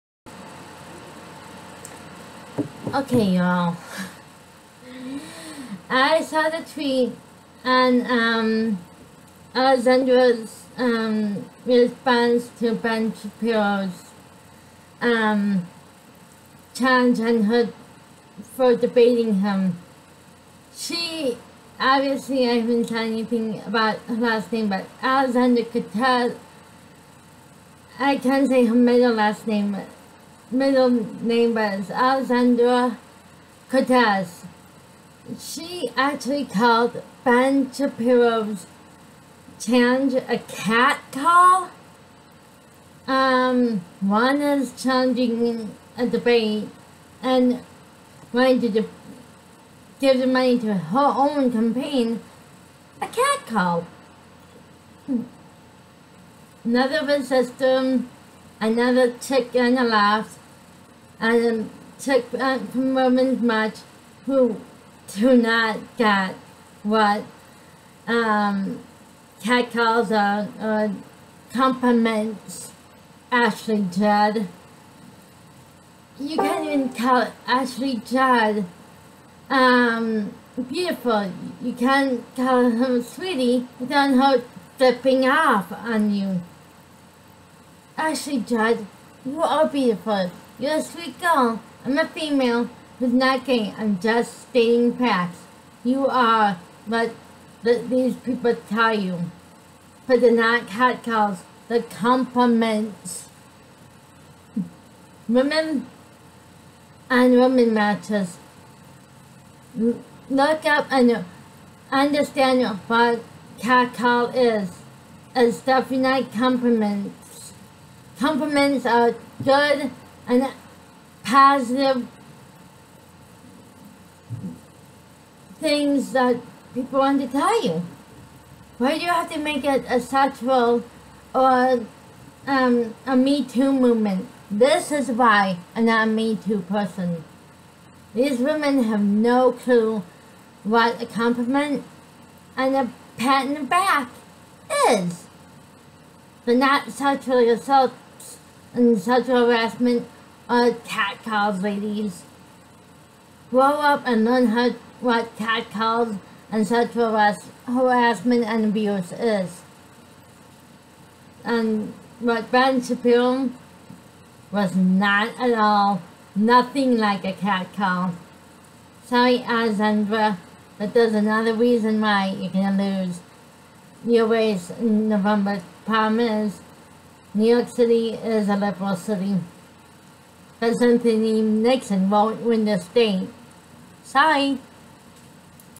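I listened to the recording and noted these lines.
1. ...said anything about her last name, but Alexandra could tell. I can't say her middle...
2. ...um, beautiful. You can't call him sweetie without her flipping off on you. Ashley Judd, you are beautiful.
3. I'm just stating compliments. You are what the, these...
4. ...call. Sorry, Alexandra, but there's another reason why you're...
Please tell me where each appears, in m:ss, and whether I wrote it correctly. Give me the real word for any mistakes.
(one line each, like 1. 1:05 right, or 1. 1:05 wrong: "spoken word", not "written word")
1. 0:22 right
2. 1:19 right
3. 1:33 wrong: "facts", not "compliments"
4. 2:47 right.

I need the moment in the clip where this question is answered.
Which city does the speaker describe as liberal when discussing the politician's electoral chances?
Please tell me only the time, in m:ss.
2:57.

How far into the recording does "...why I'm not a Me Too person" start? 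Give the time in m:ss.
2:15.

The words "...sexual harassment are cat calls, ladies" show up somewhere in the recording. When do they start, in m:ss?
2:29.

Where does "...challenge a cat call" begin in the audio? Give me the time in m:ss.
0:39.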